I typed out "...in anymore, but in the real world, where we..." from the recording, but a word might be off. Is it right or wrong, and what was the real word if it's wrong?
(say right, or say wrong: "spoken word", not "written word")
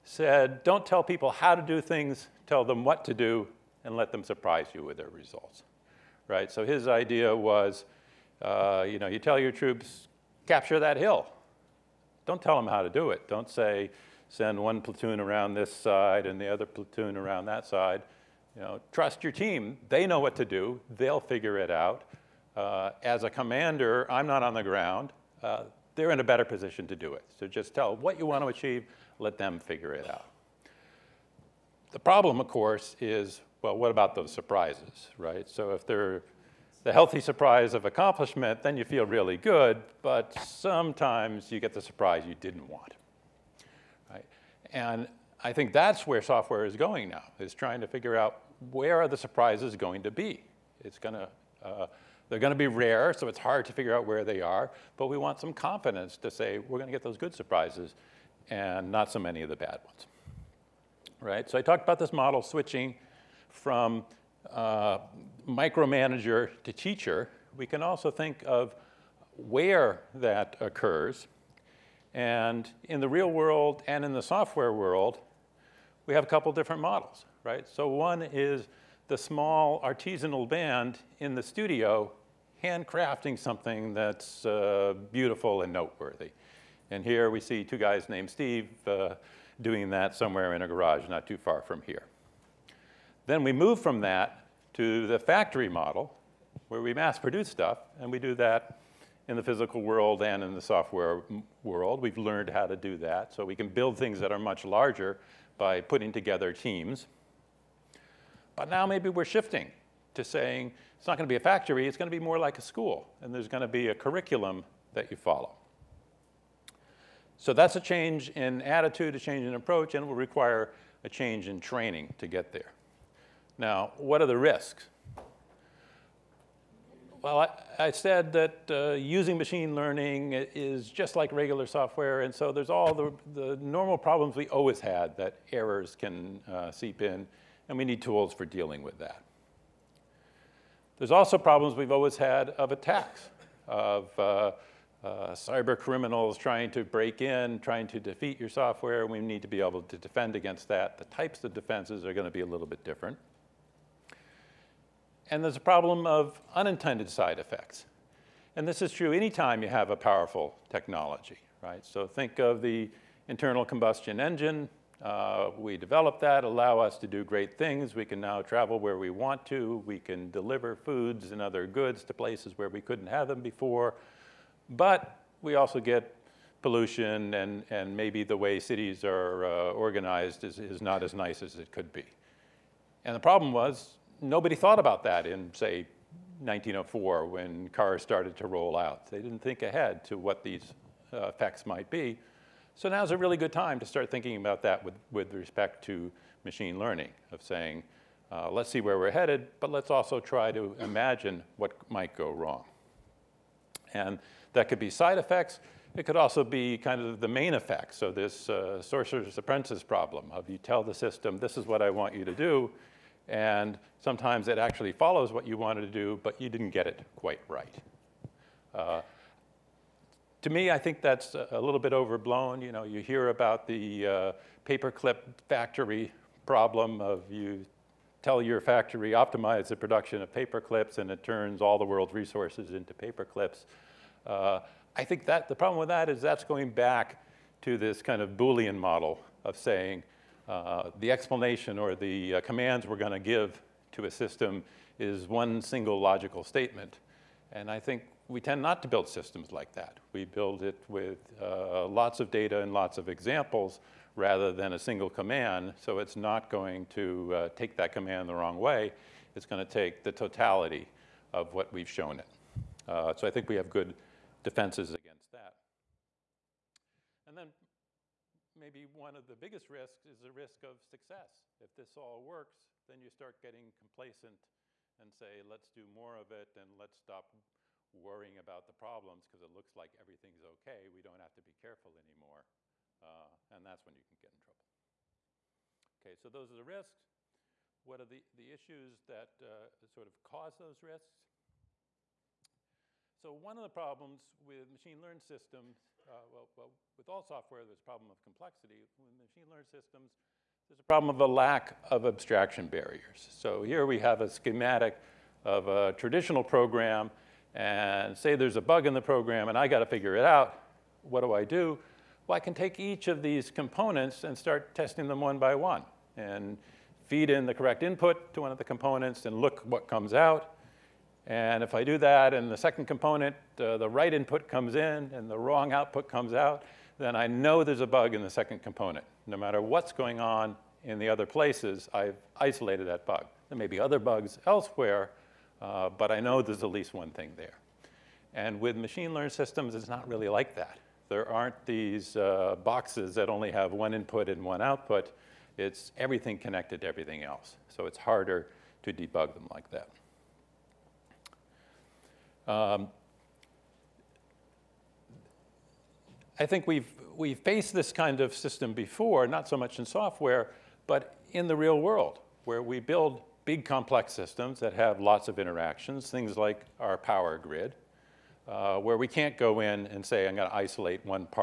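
wrong: "software", not "anymore".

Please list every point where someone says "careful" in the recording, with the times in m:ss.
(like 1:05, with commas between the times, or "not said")
4:41.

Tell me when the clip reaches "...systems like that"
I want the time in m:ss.
4:09.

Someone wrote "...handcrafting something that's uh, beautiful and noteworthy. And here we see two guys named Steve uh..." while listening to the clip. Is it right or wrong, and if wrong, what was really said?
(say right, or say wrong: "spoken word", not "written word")
right.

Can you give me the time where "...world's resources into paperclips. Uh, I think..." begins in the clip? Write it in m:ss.
3:51.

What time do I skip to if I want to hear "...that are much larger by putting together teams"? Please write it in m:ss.
1:44.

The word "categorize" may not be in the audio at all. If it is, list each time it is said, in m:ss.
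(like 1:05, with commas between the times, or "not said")
not said.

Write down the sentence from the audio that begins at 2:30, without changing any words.
The types of defenses are going to be a little bit different.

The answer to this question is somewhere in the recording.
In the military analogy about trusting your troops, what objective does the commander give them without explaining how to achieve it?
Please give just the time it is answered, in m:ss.
0:10.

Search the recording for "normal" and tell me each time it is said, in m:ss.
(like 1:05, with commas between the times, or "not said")
2:13.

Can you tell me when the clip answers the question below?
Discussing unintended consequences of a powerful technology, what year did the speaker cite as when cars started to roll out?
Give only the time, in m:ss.
3:06.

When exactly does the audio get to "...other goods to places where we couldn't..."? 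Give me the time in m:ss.
2:51.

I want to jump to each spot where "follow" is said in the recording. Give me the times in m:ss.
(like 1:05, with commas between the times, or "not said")
1:55, 3:34.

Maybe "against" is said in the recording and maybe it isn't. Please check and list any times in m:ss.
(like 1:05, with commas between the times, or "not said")
2:30, 4:24.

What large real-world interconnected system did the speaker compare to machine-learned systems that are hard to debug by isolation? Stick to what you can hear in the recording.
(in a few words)
Power grid.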